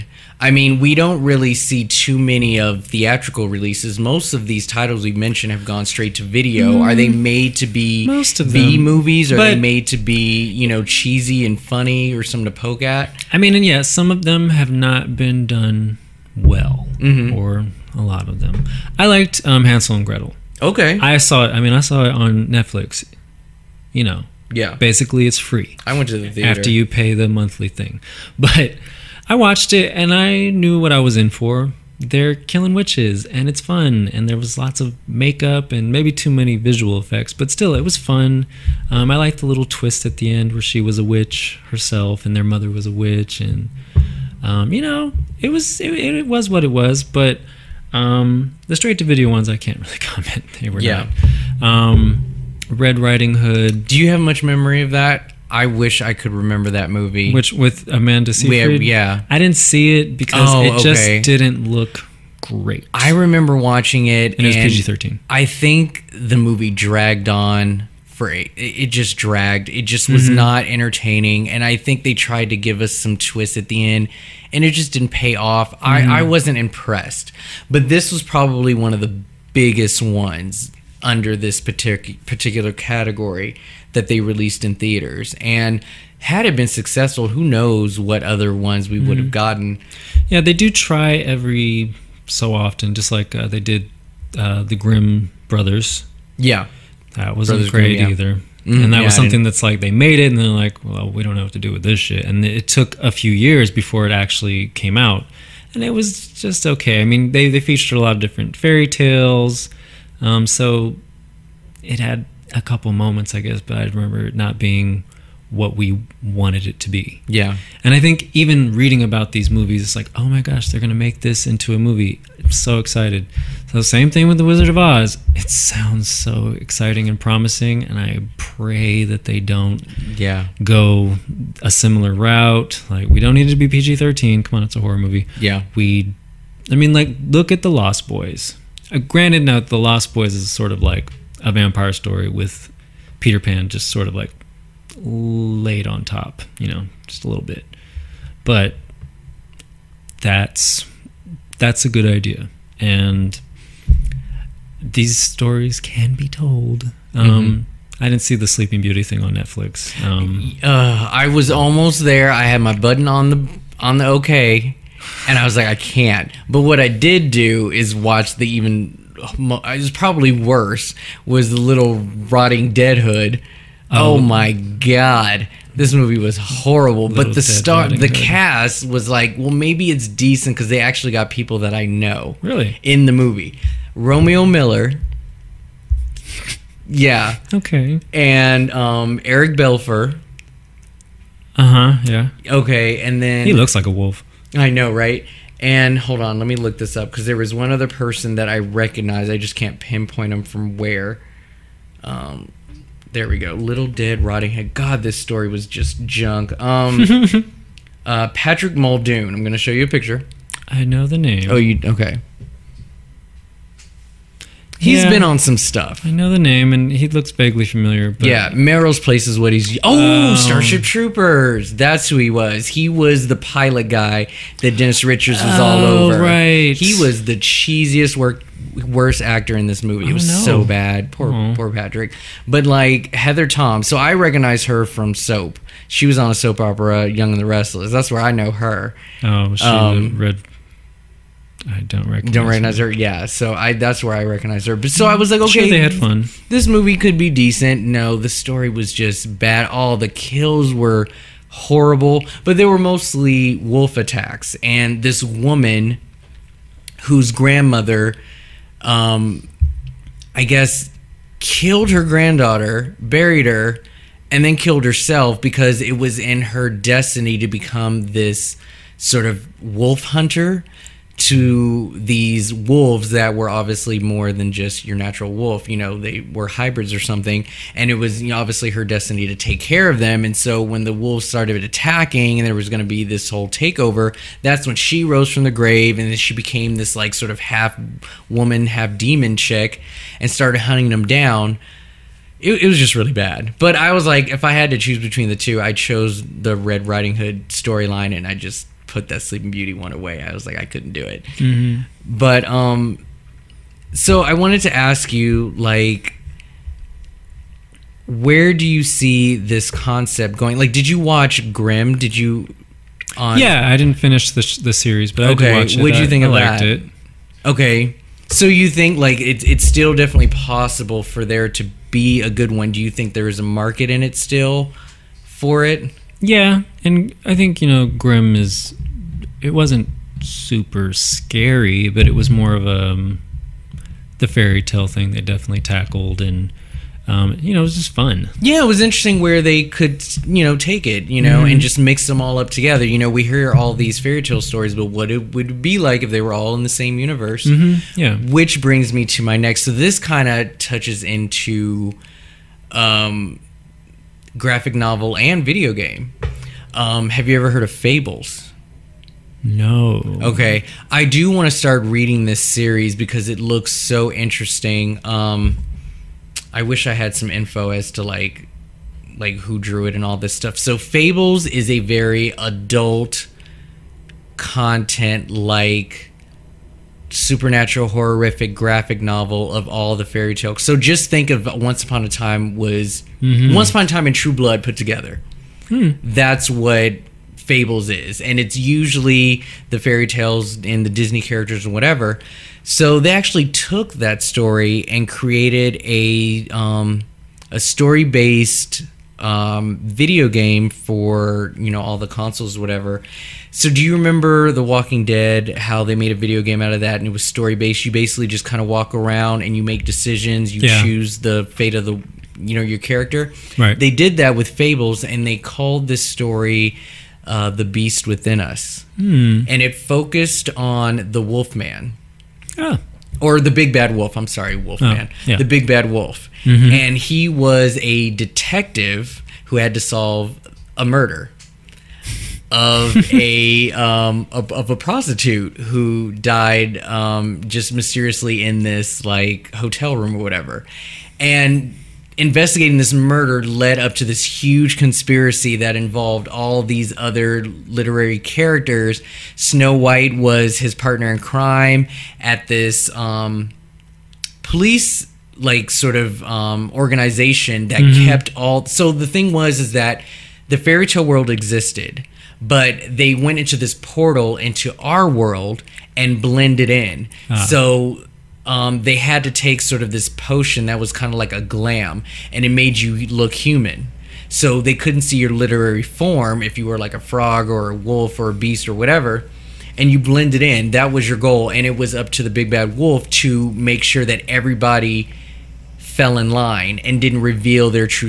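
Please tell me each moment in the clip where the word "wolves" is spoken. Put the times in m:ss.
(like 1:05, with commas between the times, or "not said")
4:32, 4:40.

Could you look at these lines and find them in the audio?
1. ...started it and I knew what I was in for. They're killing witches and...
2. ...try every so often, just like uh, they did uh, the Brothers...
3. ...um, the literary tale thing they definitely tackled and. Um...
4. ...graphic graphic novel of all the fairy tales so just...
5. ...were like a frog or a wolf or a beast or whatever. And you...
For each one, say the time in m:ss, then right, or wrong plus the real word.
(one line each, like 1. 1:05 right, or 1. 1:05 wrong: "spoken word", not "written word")
1. 0:29 wrong: "watched", not "started"
2. 1:30 wrong: "Grimm", not "Brothers"
3. 5:32 wrong: "fairy", not "literary"
4. 6:17 wrong: "horrific", not "graphic"
5. 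7:56 right.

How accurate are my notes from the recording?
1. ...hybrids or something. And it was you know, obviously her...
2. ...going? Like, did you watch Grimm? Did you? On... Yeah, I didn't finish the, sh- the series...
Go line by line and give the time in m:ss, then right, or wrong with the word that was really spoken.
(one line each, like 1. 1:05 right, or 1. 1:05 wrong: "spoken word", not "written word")
1. 4:36 right
2. 5:10 right.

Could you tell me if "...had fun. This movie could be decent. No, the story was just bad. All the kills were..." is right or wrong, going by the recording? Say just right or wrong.
right.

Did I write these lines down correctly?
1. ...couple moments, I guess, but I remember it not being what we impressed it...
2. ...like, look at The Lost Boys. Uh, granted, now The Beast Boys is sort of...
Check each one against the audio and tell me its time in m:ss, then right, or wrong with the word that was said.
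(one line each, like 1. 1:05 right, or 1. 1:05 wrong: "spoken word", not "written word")
1. 1:52 wrong: "wanted", not "impressed"
2. 2:16 wrong: "Lost", not "Beast".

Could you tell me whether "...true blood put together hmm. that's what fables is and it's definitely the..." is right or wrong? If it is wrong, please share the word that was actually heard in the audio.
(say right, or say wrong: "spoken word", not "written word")
wrong: "usually", not "definitely".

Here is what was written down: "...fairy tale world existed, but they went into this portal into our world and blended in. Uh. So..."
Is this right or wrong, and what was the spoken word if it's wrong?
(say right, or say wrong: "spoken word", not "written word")
right.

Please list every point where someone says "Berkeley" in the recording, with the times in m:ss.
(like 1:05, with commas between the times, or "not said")
not said.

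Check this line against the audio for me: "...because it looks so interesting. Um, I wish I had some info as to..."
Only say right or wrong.
right.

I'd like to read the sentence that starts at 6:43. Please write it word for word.
So, do you remember The Walking Dead?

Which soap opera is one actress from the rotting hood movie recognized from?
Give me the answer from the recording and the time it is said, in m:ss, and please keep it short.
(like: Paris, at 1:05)
Young and the Restless, at 3:57.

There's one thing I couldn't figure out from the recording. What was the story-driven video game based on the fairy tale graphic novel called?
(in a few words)
The Beast Within Us.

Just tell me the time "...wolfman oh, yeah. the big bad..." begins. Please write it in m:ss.
7:04.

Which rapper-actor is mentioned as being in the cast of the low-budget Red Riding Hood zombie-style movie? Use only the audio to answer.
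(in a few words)
Romeo Miller.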